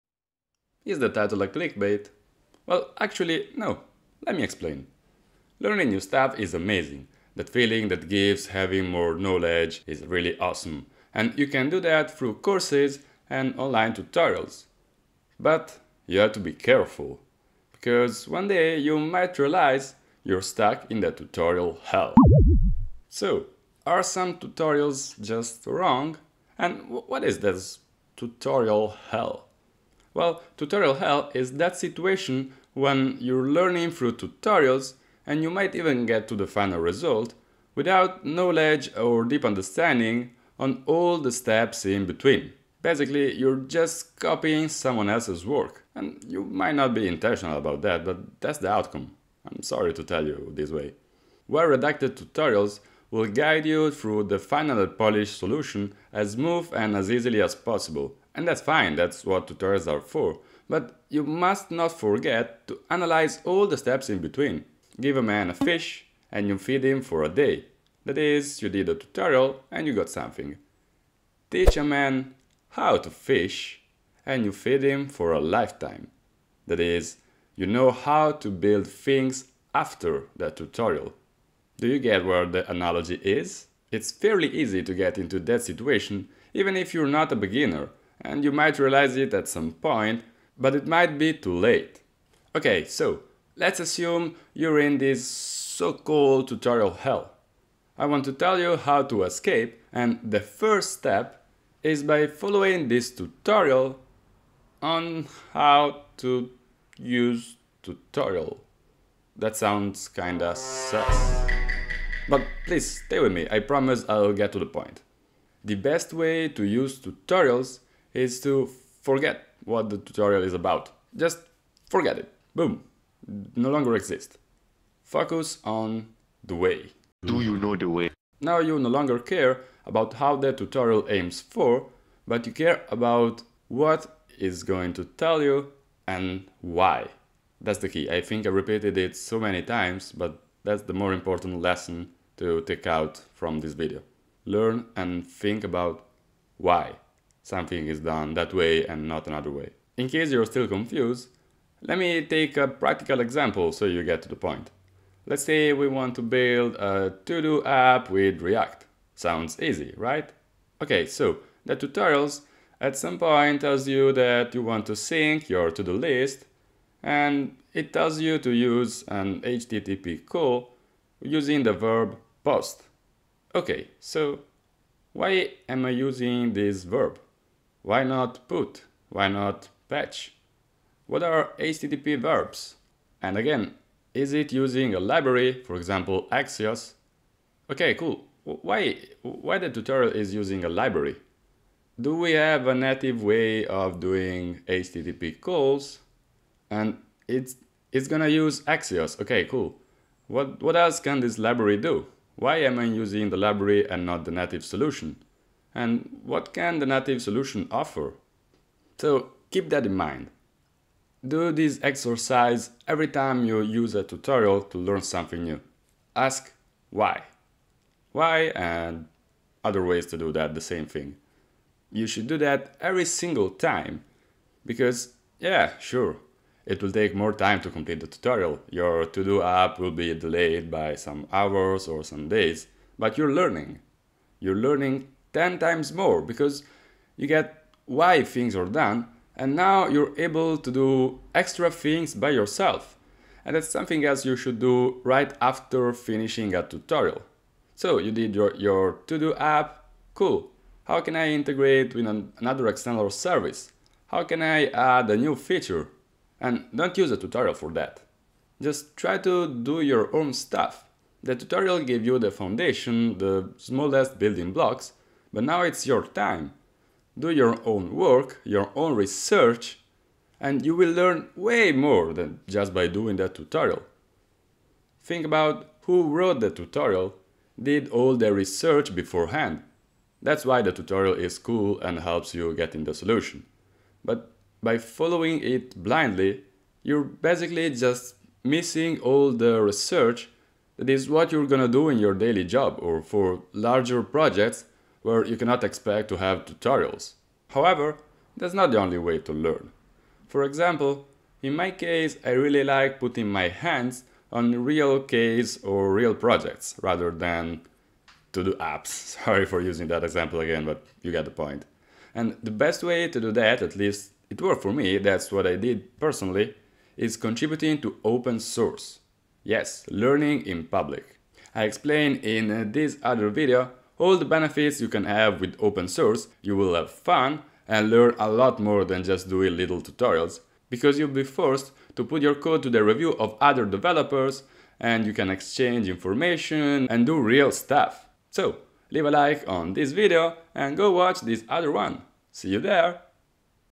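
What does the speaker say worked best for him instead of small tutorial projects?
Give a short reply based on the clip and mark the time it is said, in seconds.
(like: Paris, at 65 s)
contributing to open source, at 317 s.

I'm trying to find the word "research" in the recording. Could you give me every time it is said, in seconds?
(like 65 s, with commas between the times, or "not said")
268 s, 278 s, 289 s.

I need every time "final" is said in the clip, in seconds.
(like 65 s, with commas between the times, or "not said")
36 s, 54 s.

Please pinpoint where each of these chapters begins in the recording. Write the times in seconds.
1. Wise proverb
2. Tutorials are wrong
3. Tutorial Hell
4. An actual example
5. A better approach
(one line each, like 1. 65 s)
1. 64 s
2. 260 s
3. 28 s
4. 150 s
5. 297 s.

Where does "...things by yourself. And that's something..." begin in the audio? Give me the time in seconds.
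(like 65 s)
241 s.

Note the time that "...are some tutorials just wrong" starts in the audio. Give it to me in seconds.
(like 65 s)
23 s.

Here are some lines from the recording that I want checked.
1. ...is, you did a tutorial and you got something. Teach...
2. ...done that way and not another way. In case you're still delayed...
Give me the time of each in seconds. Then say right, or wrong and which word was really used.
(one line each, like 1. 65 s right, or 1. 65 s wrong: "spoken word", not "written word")
1. 68 s right
2. 147 s wrong: "confused", not "delayed".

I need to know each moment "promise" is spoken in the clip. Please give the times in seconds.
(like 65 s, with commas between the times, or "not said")
113 s.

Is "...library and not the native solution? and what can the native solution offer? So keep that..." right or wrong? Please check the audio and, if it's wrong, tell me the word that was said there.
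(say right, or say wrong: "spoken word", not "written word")
right.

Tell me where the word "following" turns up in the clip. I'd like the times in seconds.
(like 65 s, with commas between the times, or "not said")
102 s, 284 s.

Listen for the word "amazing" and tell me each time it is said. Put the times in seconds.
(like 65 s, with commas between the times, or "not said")
6 s.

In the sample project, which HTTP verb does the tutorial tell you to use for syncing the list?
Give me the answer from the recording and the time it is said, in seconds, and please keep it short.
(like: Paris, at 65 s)
POST, at 172 s.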